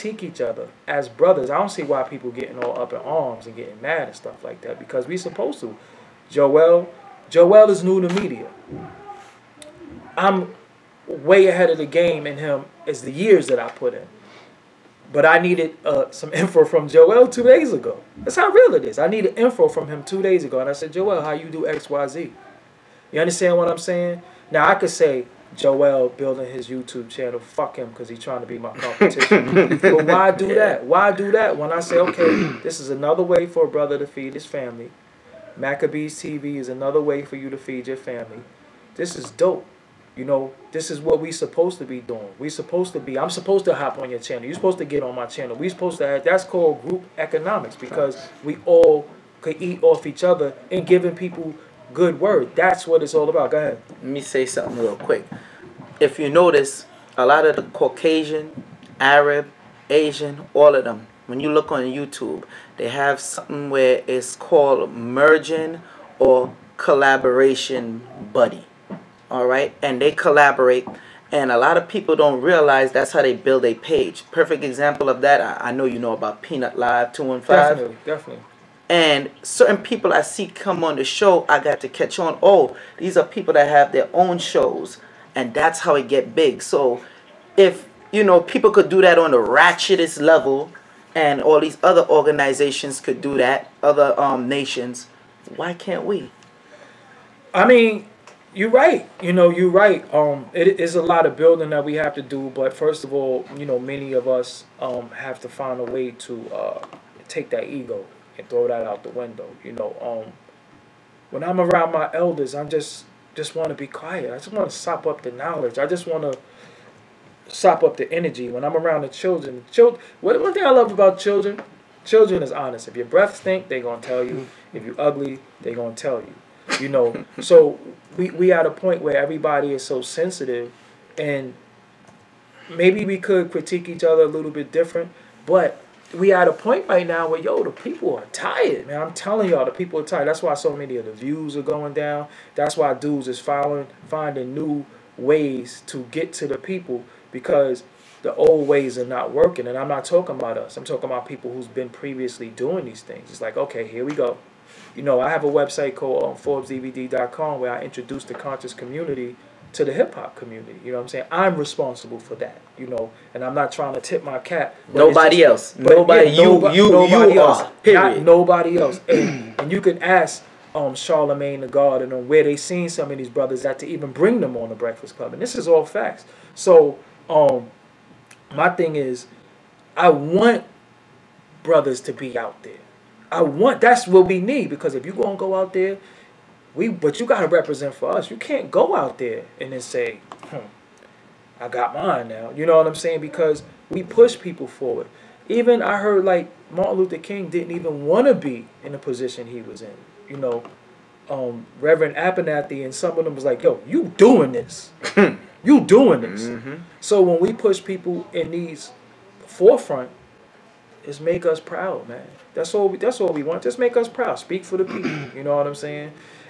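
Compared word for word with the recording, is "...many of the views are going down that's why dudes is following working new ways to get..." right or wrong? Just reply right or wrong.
wrong.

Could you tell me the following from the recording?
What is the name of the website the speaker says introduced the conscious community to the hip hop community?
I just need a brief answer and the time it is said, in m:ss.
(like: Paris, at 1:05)
ForbesDVD.com, at 2:36.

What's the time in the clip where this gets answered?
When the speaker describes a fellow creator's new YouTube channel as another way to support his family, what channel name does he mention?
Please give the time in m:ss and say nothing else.
0:35.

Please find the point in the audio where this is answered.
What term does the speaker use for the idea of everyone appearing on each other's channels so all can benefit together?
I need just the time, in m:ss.
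0:46.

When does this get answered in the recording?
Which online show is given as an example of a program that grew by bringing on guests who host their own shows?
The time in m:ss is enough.
1:16.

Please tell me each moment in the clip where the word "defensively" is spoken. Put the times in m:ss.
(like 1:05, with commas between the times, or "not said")
not said.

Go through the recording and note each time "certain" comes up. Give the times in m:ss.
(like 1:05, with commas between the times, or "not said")
1:19.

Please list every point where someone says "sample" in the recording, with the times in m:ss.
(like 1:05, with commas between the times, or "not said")
not said.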